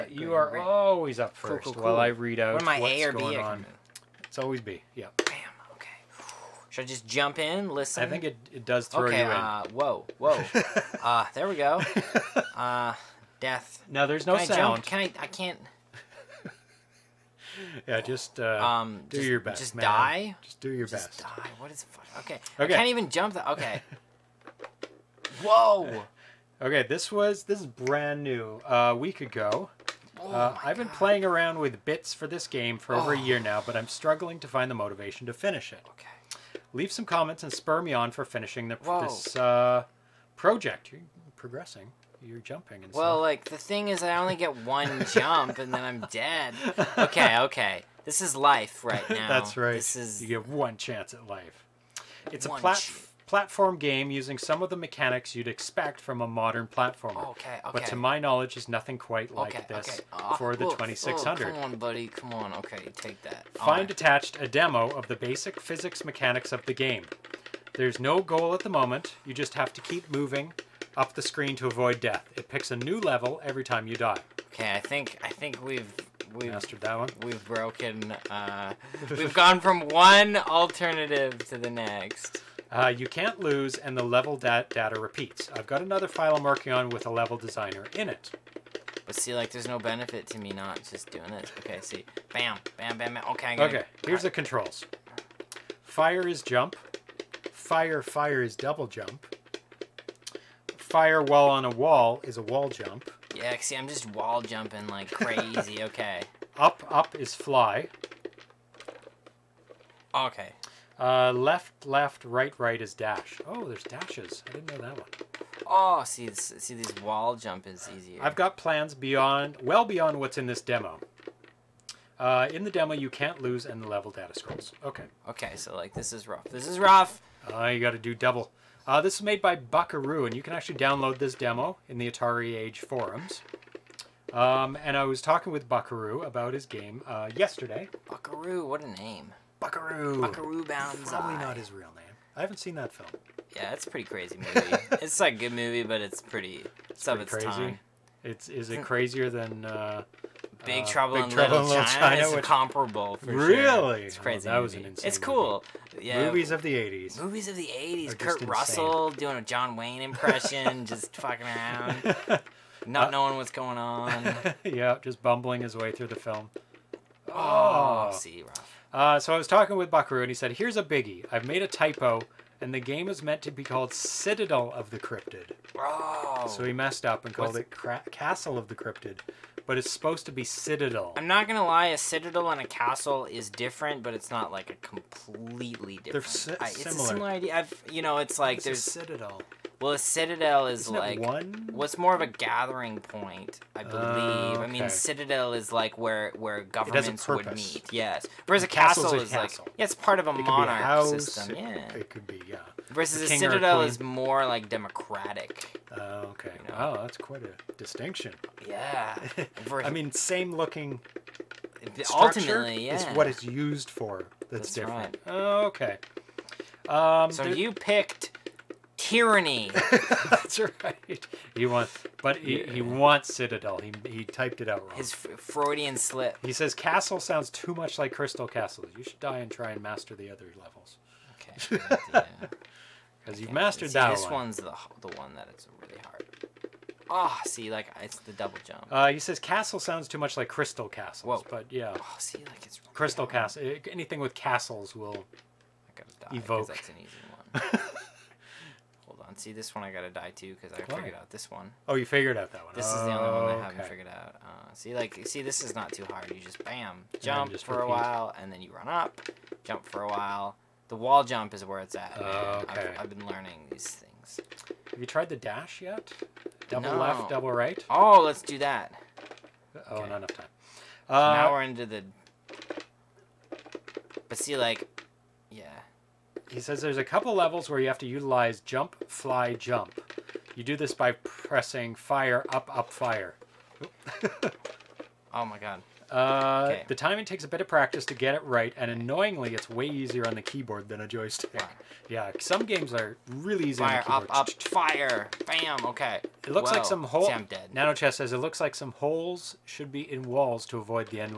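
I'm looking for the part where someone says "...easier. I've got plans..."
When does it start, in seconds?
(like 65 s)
117 s.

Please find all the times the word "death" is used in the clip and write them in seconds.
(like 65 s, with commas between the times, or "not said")
13 s, 71 s.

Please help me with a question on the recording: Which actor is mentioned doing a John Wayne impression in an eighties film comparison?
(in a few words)
Kurt Russell.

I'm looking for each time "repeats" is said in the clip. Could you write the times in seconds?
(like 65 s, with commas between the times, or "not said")
84 s, 257 s.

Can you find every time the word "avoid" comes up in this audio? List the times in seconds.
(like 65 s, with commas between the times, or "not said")
71 s, 300 s.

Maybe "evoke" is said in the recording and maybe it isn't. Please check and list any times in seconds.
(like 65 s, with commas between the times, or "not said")
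246 s.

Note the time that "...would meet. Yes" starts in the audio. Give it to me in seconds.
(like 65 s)
197 s.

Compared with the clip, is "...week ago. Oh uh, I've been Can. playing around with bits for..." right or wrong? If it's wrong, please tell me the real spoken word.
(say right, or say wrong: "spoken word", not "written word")
wrong: "God", not "Can".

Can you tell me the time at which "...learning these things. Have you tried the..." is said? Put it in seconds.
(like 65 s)
263 s.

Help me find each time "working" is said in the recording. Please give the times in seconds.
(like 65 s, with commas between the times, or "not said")
86 s.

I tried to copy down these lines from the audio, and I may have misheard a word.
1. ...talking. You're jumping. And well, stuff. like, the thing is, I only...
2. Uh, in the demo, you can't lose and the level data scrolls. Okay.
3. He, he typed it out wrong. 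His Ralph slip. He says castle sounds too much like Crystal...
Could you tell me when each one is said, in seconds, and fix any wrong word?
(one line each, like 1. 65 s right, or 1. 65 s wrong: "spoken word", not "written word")
1. 41 s wrong: "progressing", not "talking"
2. 122 s right
3. 223 s wrong: "Freudian", not "Ralph".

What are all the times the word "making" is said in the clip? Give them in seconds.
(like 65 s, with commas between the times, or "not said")
not said.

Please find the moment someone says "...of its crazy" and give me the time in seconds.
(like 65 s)
147 s.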